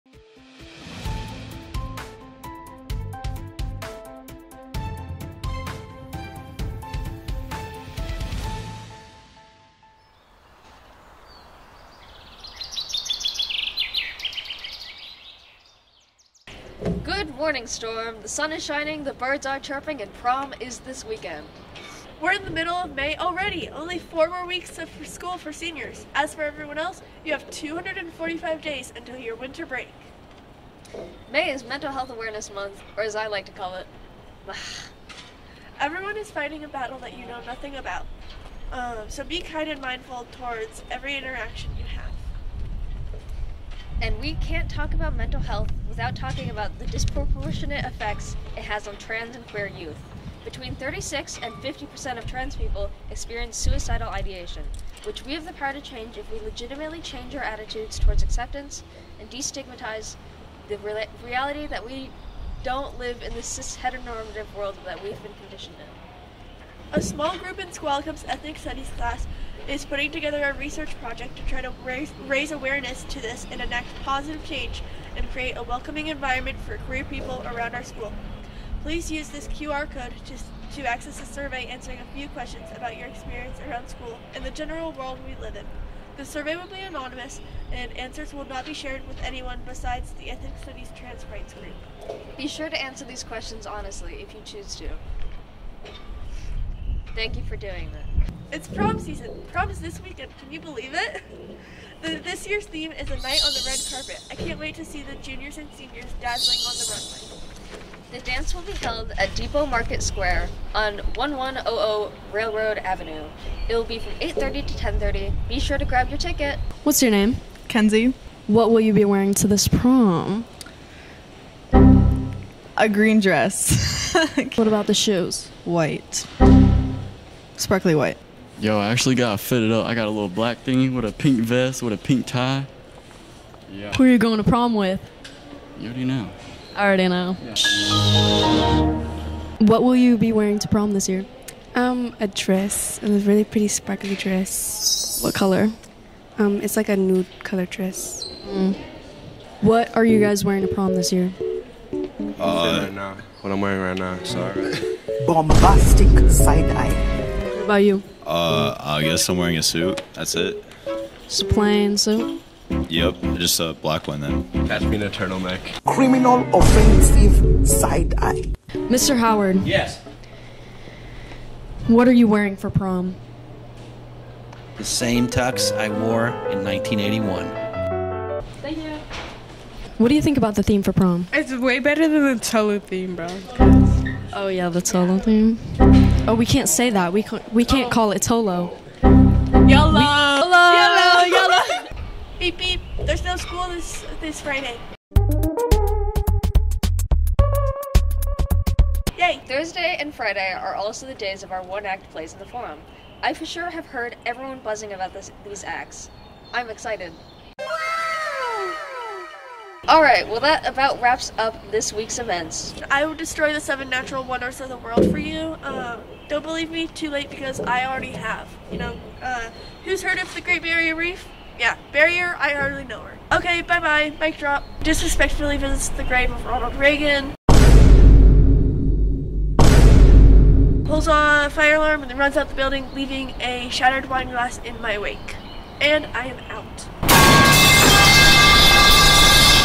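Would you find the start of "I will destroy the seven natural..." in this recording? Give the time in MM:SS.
03:32.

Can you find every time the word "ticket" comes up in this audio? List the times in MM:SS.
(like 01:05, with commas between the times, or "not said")
01:56.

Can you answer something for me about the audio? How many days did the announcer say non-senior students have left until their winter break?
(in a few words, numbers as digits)
245.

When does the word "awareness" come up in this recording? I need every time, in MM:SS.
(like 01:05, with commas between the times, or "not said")
00:32, 01:12.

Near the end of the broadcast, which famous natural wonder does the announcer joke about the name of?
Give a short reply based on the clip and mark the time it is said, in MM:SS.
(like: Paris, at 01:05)
Great Barrier Reef, at 03:40.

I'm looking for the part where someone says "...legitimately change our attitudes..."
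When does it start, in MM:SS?
00:56.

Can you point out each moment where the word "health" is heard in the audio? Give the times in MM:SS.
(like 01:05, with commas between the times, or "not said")
00:31, 00:45.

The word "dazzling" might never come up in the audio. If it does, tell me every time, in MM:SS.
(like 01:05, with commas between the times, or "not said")
01:46.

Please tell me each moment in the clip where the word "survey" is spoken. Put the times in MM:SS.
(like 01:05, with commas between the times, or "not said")
01:21, 01:26.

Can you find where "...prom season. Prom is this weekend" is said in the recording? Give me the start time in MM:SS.
01:38.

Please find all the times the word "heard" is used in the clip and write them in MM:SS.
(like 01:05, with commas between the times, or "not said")
03:23, 03:40.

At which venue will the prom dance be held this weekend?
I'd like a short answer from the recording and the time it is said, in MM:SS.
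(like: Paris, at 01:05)
Depot Market Square, at 01:49.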